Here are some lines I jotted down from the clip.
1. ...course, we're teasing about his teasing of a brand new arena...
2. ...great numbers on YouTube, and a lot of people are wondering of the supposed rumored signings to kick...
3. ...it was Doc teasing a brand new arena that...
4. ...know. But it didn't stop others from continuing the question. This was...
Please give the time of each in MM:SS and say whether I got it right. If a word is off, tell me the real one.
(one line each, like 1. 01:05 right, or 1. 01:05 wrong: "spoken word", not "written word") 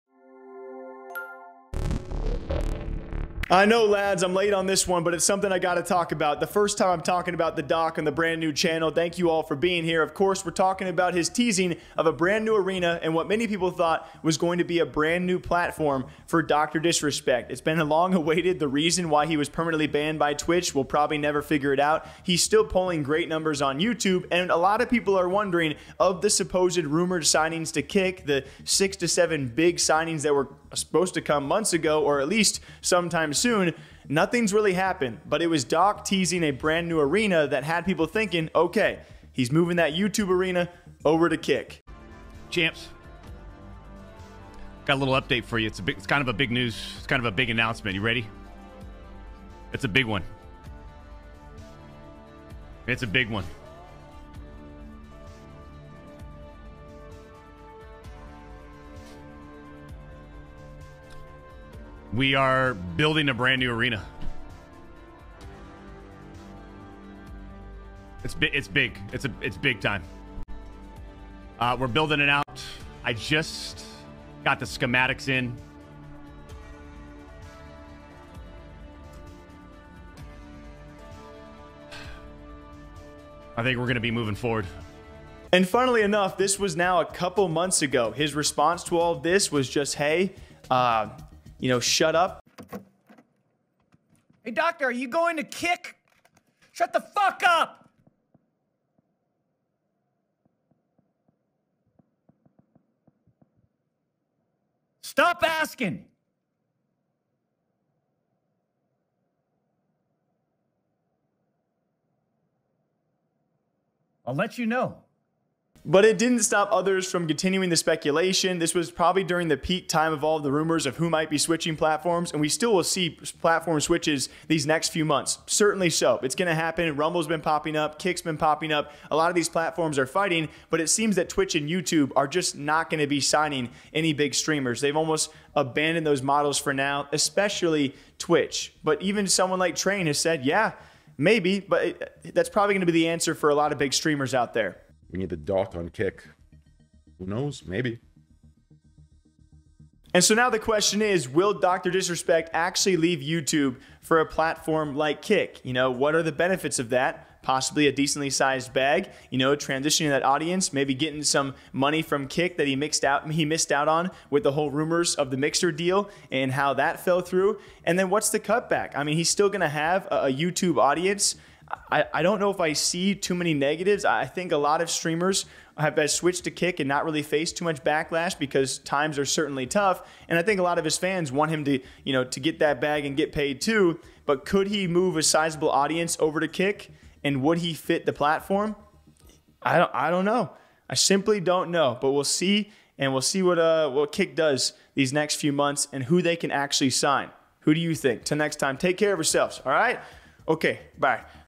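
1. 00:10 wrong: "talking", not "teasing"
2. 00:23 right
3. 00:35 right
4. 01:54 wrong: "speculation", not "question".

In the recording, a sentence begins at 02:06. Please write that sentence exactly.
Rumble's been popping up, Kick's been popping up.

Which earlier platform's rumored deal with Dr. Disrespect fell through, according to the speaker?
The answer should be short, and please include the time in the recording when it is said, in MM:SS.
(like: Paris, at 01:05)
Mixer, at 02:45.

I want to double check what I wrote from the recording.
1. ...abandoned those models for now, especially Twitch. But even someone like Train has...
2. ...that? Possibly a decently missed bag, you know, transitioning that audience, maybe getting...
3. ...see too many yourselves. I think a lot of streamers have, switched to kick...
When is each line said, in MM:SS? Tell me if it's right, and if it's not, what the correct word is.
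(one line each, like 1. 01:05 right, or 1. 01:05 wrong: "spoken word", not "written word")
1. 02:15 right
2. 02:36 wrong: "sized", not "missed"
3. 02:52 wrong: "negatives", not "yourselves".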